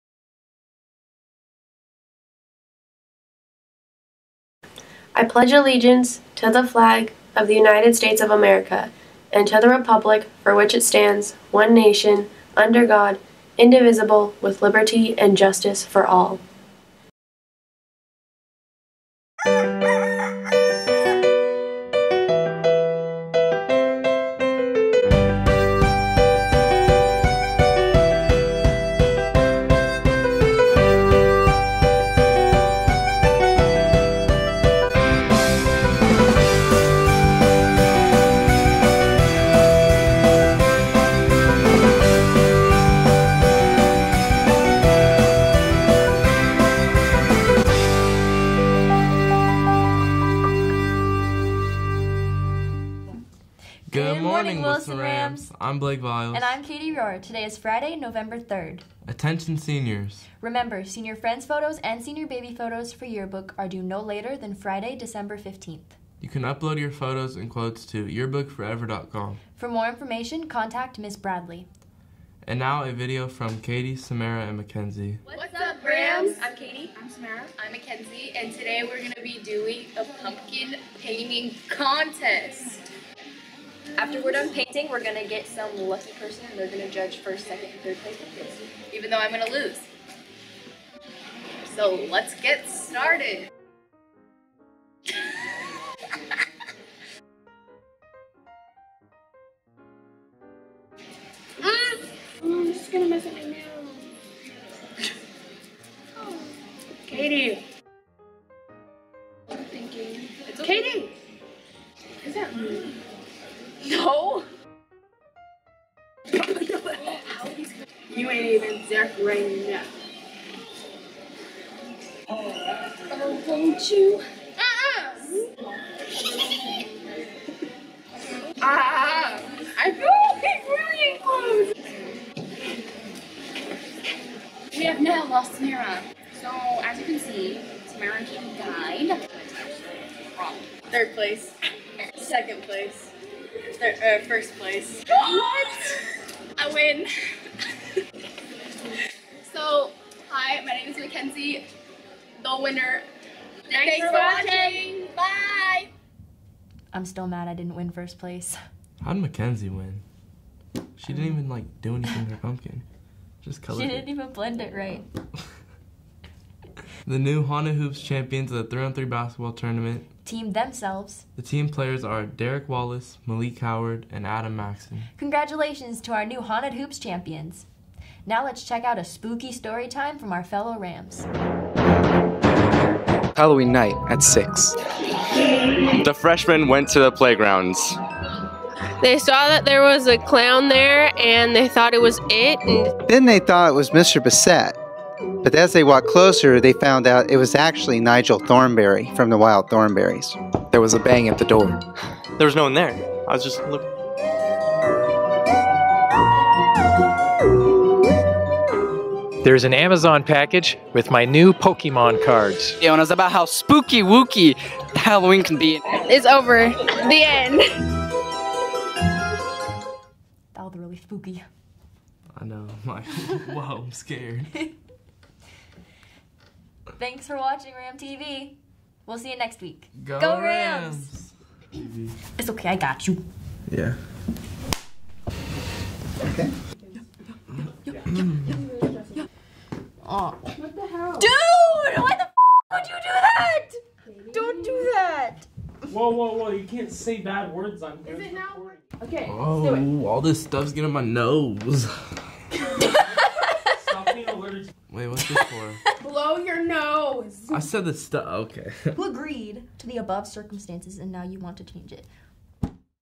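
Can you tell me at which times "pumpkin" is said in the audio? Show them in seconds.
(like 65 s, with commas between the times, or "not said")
80 s, 162 s.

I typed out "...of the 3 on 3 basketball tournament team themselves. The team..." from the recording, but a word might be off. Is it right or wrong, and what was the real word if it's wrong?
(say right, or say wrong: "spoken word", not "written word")
right.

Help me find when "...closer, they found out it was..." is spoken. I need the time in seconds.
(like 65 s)
196 s.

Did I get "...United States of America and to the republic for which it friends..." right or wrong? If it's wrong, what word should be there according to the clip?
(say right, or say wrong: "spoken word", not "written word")
wrong: "stands", not "friends".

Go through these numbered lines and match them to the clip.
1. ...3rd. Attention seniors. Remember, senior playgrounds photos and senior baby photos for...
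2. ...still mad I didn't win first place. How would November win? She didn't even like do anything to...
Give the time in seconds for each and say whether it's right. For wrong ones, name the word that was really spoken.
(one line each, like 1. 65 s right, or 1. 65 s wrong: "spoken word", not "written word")
1. 58 s wrong: "friends", not "playgrounds"
2. 157 s wrong: "Mackenzie", not "November".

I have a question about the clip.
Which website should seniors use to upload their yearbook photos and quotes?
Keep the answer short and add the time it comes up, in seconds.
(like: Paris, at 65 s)
yearbookforever.com, at 68 s.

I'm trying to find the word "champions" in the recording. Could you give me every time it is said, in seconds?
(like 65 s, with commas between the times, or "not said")
168 s, 176 s.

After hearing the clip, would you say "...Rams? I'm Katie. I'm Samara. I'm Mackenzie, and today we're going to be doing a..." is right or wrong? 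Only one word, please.
right.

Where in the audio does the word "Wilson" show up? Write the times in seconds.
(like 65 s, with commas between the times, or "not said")
54 s.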